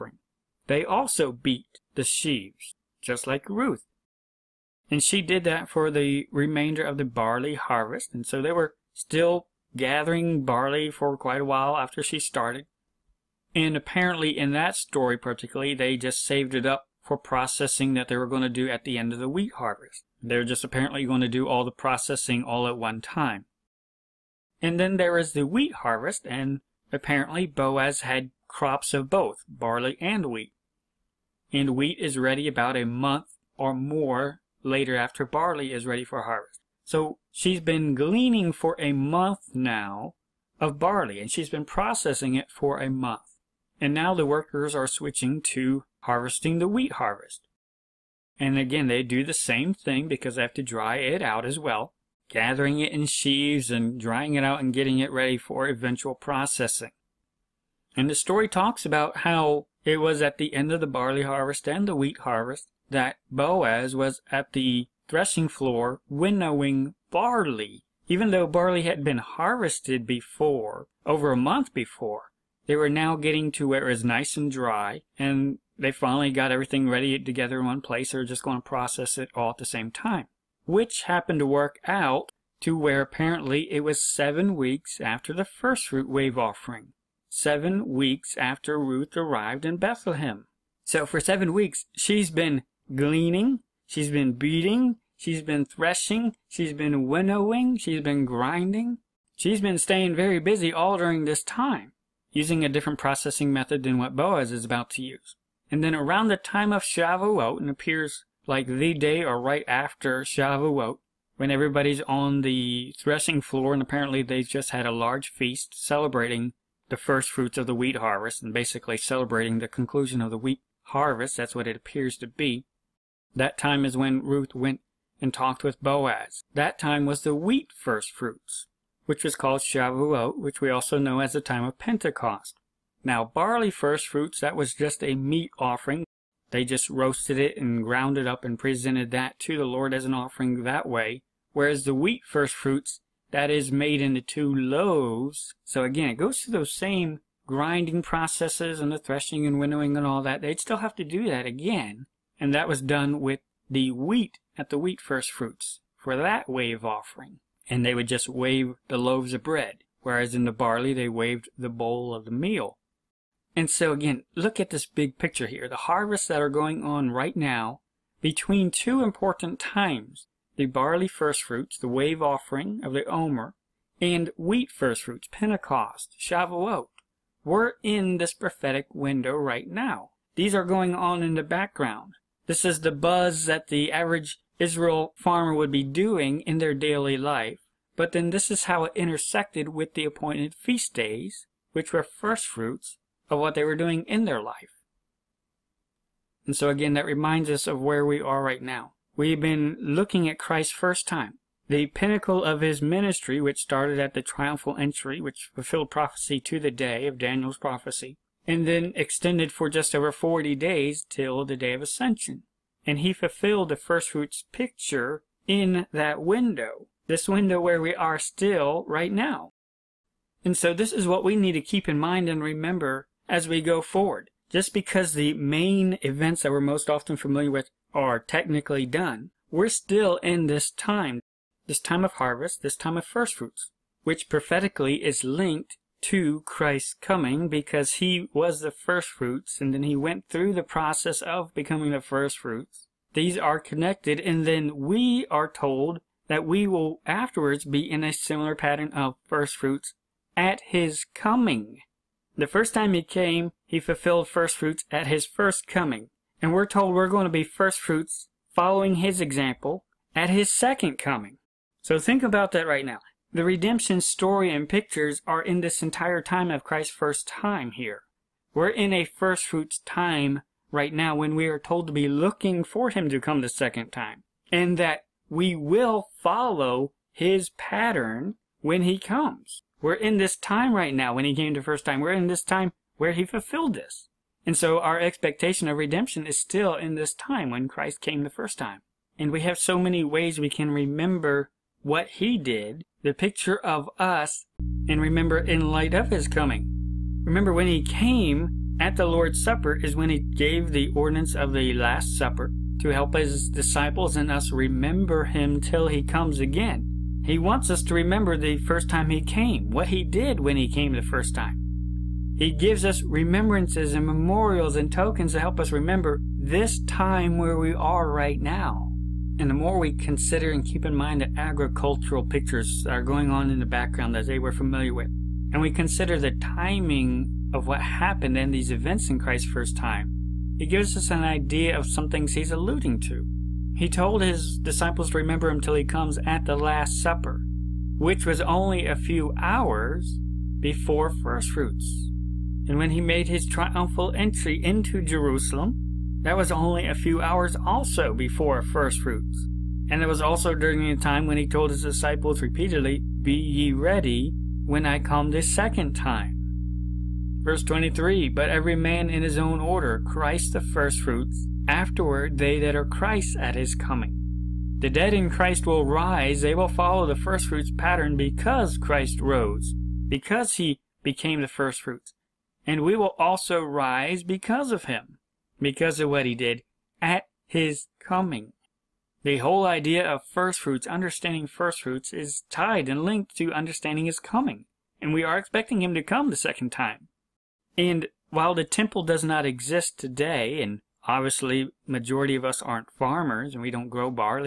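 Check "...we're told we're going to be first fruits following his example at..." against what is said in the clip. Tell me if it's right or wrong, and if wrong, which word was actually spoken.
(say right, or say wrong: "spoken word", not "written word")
right.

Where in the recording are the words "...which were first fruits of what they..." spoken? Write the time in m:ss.
3:11.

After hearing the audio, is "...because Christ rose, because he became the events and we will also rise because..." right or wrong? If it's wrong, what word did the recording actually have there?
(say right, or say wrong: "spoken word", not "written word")
wrong: "firstfruits", not "events".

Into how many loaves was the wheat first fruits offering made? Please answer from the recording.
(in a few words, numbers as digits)
2.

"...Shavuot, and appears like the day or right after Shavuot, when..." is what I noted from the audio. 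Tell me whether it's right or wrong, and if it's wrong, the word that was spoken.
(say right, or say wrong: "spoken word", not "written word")
right.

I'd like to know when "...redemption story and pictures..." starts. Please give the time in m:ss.
4:23.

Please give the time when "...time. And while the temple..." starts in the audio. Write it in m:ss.
6:26.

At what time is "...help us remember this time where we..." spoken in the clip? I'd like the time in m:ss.
5:15.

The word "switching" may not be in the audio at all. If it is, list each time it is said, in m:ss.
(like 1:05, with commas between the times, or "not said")
0:44.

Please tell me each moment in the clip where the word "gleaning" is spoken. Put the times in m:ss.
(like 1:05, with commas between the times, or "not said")
0:37, 1:32.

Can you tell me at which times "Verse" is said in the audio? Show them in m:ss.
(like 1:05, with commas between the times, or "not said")
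5:57.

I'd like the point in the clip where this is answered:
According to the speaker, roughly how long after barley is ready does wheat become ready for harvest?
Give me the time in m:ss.
0:32.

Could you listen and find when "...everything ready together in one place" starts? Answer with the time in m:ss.
1:16.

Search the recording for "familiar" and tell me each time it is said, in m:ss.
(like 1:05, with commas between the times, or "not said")
3:47, 5:24.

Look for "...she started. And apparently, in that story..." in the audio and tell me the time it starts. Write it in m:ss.
0:12.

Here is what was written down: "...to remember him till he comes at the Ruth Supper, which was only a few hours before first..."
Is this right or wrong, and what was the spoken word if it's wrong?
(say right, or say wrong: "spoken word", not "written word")
wrong: "Last", not "Ruth".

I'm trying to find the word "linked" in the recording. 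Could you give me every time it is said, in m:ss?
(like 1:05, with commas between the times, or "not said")
3:55, 6:23.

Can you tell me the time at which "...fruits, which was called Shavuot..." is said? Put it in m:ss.
2:08.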